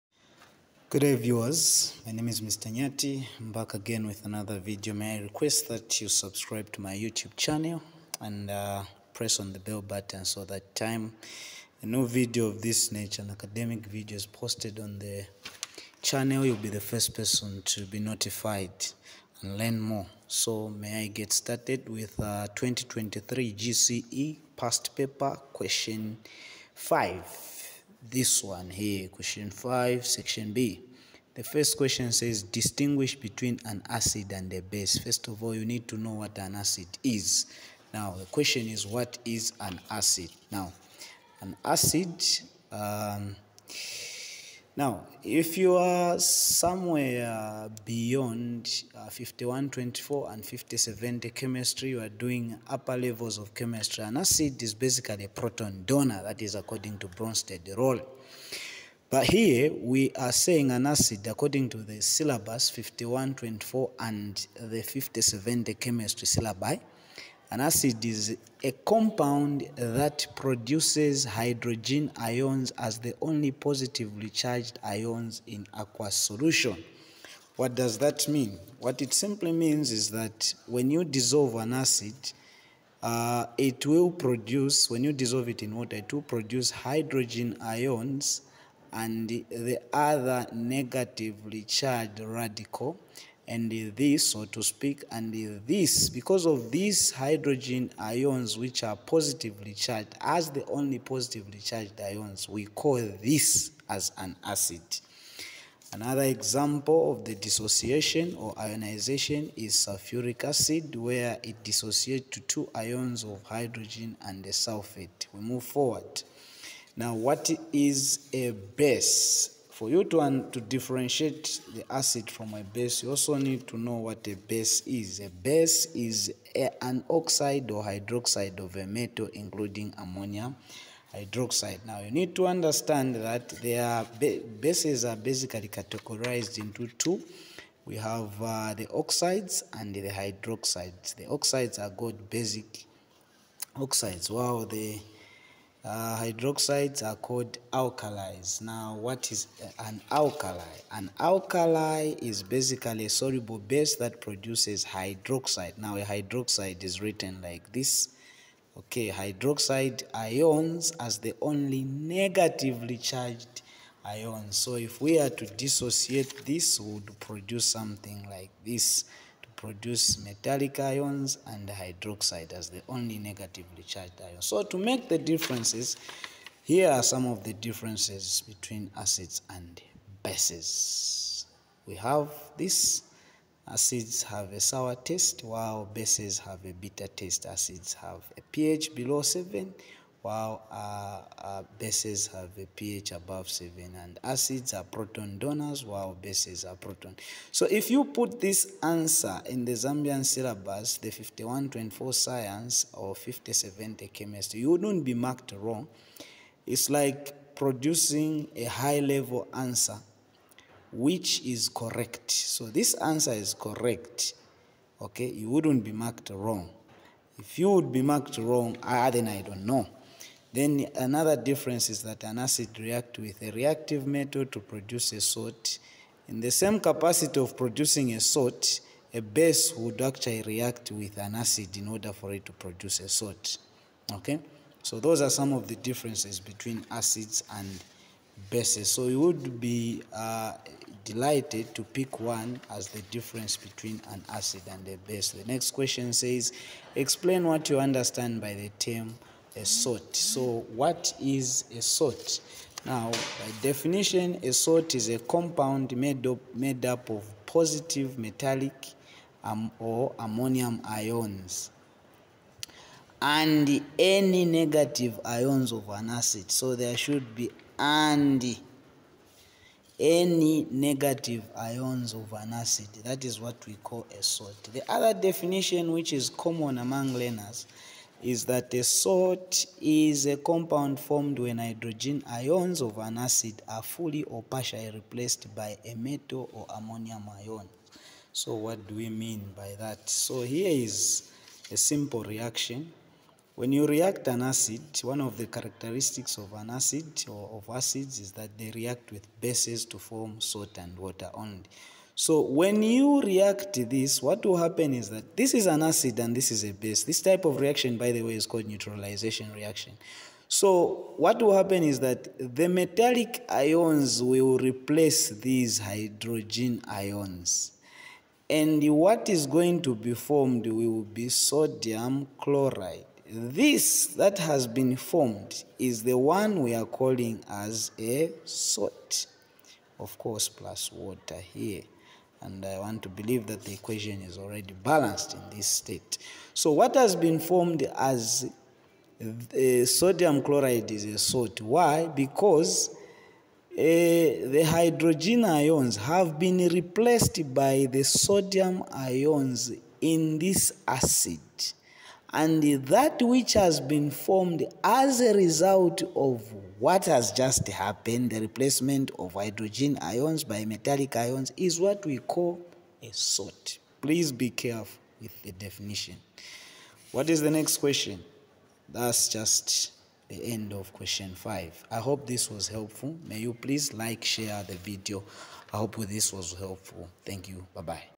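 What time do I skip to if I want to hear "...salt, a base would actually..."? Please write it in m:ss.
3:48.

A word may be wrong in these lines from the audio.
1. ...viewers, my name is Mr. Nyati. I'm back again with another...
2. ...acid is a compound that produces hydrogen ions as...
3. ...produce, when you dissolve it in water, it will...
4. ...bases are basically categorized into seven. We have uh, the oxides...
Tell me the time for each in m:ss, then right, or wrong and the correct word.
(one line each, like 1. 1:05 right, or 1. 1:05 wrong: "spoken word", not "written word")
1. 0:01 right
2. 1:07 right
3. 1:24 right
4. 2:14 wrong: "two", not "seven".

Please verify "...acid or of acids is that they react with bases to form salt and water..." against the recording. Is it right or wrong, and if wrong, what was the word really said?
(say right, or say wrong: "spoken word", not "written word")
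right.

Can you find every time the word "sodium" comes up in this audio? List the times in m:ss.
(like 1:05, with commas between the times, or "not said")
5:21, 5:39, 5:48.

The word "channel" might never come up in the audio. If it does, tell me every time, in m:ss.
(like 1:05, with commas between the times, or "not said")
0:07, 0:16.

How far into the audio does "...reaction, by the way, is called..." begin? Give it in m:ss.
5:07.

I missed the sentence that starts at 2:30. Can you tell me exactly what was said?
An alkali is basically a soluble base that produces hydroxide.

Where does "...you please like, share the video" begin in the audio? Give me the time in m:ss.
6:13.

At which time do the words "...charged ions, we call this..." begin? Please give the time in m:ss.
1:41.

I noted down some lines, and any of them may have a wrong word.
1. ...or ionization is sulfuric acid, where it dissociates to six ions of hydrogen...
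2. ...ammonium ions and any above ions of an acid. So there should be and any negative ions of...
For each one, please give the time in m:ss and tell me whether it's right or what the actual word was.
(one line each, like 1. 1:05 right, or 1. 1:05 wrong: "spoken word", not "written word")
1. 1:48 wrong: "two", not "six"
2. 4:20 wrong: "negative", not "above".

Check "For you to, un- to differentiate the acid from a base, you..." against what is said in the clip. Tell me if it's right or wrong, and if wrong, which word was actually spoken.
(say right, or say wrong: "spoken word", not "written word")
right.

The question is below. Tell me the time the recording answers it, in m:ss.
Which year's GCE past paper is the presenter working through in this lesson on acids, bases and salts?
0:22.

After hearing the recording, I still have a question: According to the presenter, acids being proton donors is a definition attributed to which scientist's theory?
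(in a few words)
Bronsted.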